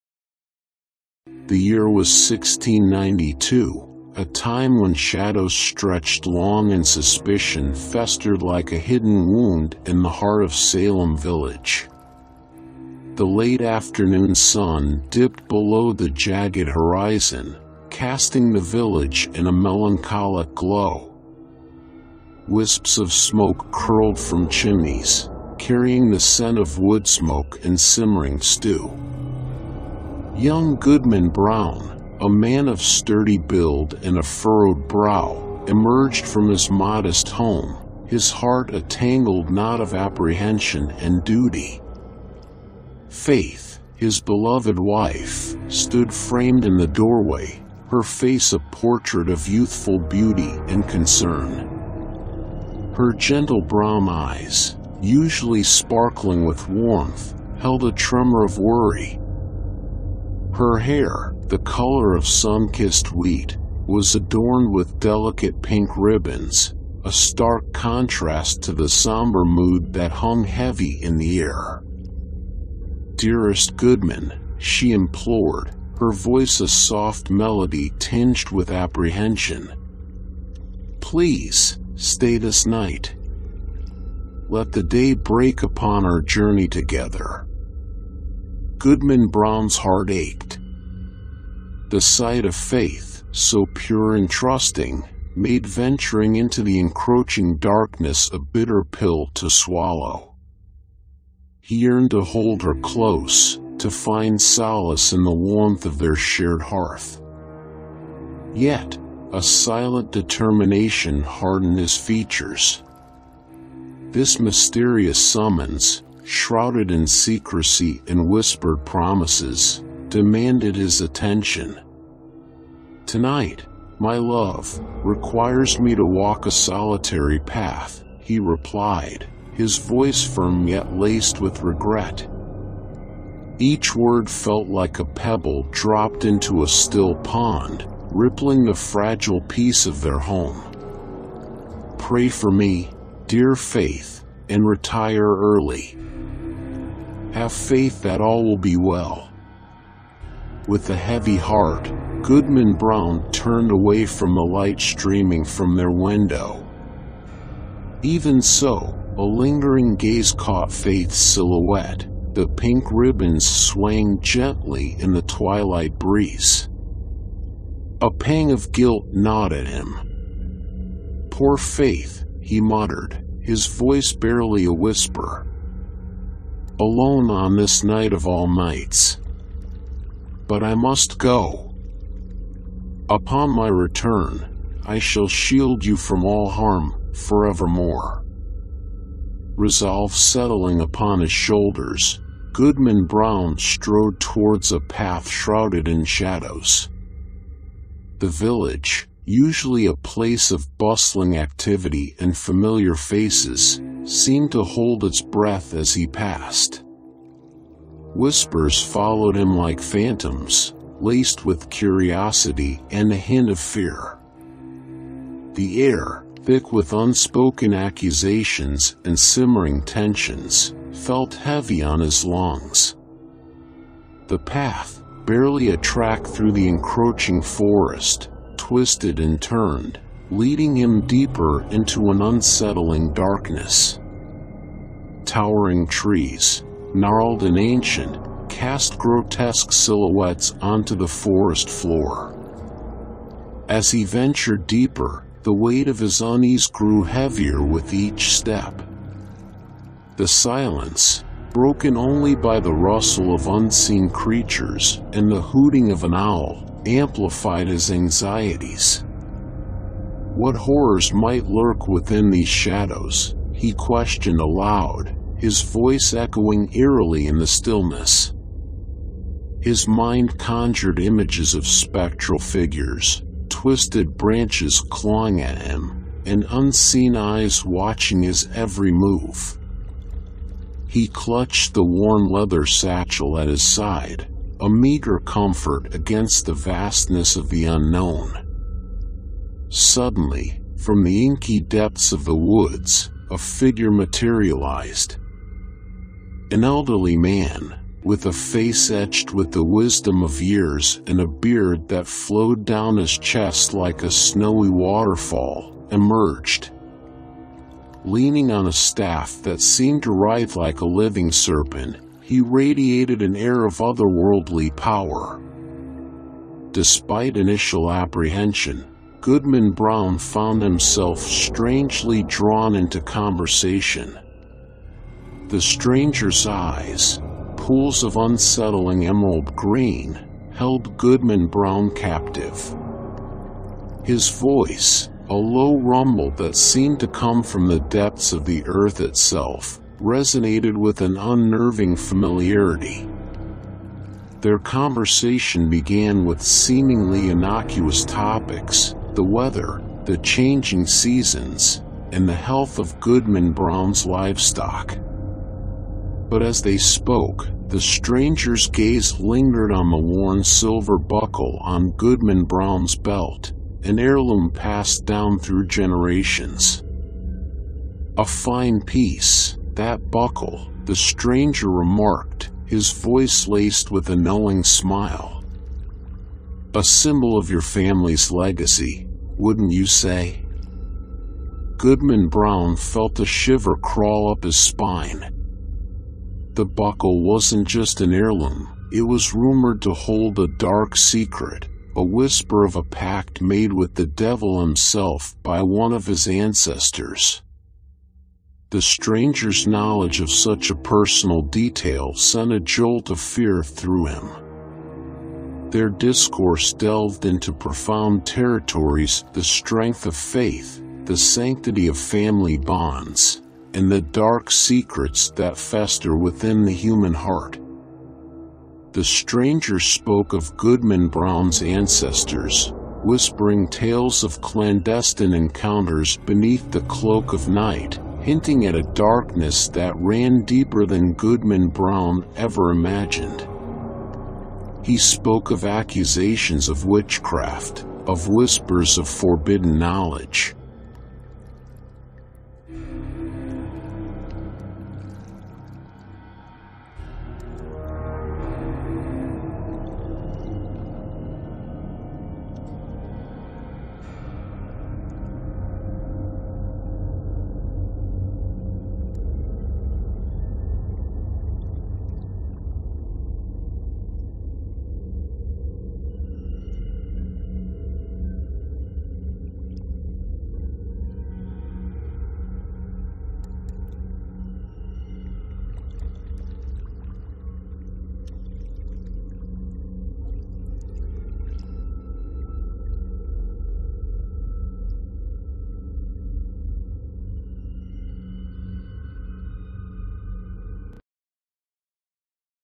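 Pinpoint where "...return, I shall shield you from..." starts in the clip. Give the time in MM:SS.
03:03.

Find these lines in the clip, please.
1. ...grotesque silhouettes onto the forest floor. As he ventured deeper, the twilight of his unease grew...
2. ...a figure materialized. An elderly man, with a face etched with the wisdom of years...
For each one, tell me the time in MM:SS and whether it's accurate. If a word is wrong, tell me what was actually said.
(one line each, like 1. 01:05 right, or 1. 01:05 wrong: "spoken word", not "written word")
1. 03:58 wrong: "weight", not "twilight"
2. 04:53 right.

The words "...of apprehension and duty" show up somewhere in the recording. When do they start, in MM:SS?
00:39.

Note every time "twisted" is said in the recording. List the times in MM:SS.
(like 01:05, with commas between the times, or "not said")
03:48, 04:33.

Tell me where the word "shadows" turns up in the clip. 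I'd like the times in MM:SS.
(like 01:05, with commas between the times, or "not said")
00:04, 03:16, 04:22.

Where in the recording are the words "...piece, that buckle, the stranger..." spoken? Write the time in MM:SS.
06:08.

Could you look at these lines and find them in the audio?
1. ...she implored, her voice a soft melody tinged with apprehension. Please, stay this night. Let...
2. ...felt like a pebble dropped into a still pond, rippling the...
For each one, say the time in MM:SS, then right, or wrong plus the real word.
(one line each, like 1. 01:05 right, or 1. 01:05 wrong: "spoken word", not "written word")
1. 01:14 right
2. 02:14 right.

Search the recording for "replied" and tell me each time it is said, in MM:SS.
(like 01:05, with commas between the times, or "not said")
02:08.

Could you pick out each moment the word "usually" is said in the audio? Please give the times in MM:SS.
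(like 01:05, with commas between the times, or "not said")
00:55, 03:19.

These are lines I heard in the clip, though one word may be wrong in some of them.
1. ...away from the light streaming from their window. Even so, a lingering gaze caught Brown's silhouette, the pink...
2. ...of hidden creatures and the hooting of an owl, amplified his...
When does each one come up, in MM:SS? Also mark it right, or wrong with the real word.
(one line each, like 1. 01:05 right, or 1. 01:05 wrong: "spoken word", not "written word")
1. 02:33 wrong: "Faith", not "Brown"
2. 04:13 wrong: "unseen", not "hidden".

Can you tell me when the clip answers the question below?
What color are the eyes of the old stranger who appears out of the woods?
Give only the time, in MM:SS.
05:29.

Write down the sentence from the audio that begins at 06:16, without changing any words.
A symbol of your family's legacy, wouldn't you say?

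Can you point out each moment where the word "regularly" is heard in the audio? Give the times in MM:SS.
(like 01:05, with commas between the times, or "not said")
not said.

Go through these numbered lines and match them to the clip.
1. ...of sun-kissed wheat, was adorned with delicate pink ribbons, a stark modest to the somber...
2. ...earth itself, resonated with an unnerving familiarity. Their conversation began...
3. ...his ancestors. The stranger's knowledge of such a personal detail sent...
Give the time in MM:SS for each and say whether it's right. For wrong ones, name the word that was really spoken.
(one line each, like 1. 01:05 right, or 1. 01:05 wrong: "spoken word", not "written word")
1. 01:02 wrong: "contrast", not "modest"
2. 05:38 right
3. 06:36 right.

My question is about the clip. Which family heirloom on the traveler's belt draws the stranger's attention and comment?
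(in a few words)
silver buckle.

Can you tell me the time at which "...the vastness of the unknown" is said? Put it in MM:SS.
04:46.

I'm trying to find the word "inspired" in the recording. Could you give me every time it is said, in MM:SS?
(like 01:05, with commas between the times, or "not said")
not said.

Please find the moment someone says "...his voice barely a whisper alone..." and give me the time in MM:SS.
02:53.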